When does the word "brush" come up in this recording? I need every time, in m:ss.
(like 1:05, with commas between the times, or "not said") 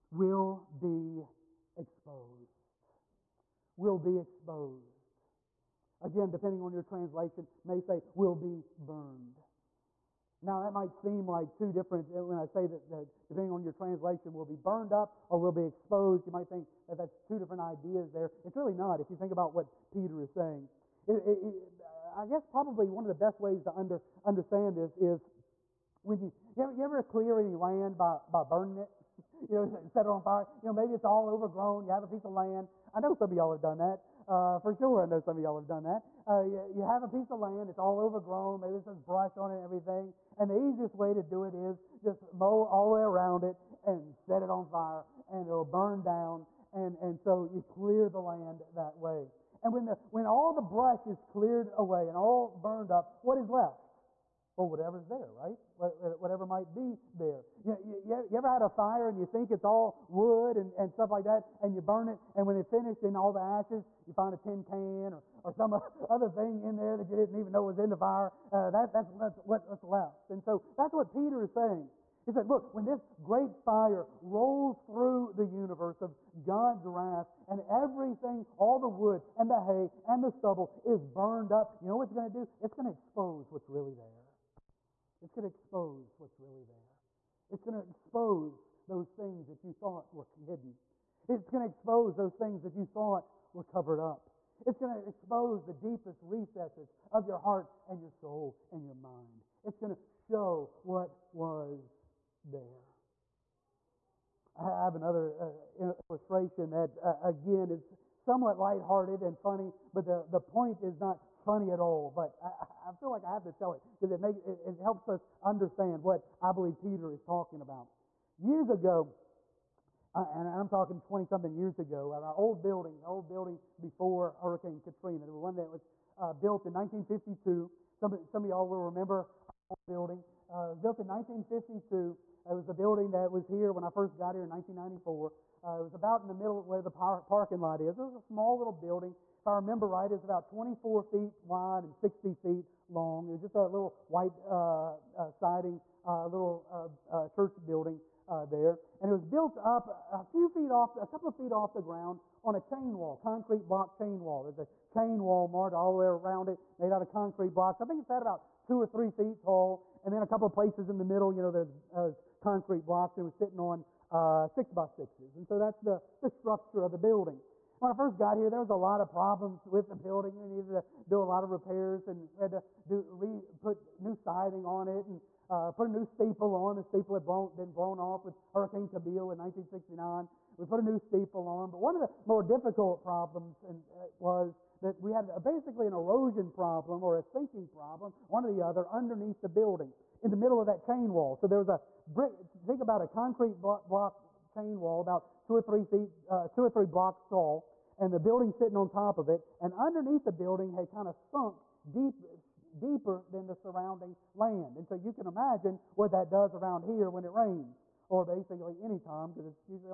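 0:39, 0:50.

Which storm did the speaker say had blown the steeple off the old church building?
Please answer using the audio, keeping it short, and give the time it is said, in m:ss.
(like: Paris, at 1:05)
Hurricane Camille, at 2:58.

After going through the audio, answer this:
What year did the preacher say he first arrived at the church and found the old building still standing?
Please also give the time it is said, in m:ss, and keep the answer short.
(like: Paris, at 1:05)
1994, at 2:14.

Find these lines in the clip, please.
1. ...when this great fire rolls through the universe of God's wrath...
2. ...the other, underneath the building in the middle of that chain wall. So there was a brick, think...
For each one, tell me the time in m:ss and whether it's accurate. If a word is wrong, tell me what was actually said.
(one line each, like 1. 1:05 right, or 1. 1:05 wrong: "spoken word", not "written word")
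1. 1:12 right
2. 3:08 right.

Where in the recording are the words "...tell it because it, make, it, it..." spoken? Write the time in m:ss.
1:53.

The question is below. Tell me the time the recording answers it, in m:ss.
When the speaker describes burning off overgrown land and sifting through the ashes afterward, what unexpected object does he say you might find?
1:04.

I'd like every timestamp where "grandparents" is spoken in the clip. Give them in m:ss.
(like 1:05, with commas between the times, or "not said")
not said.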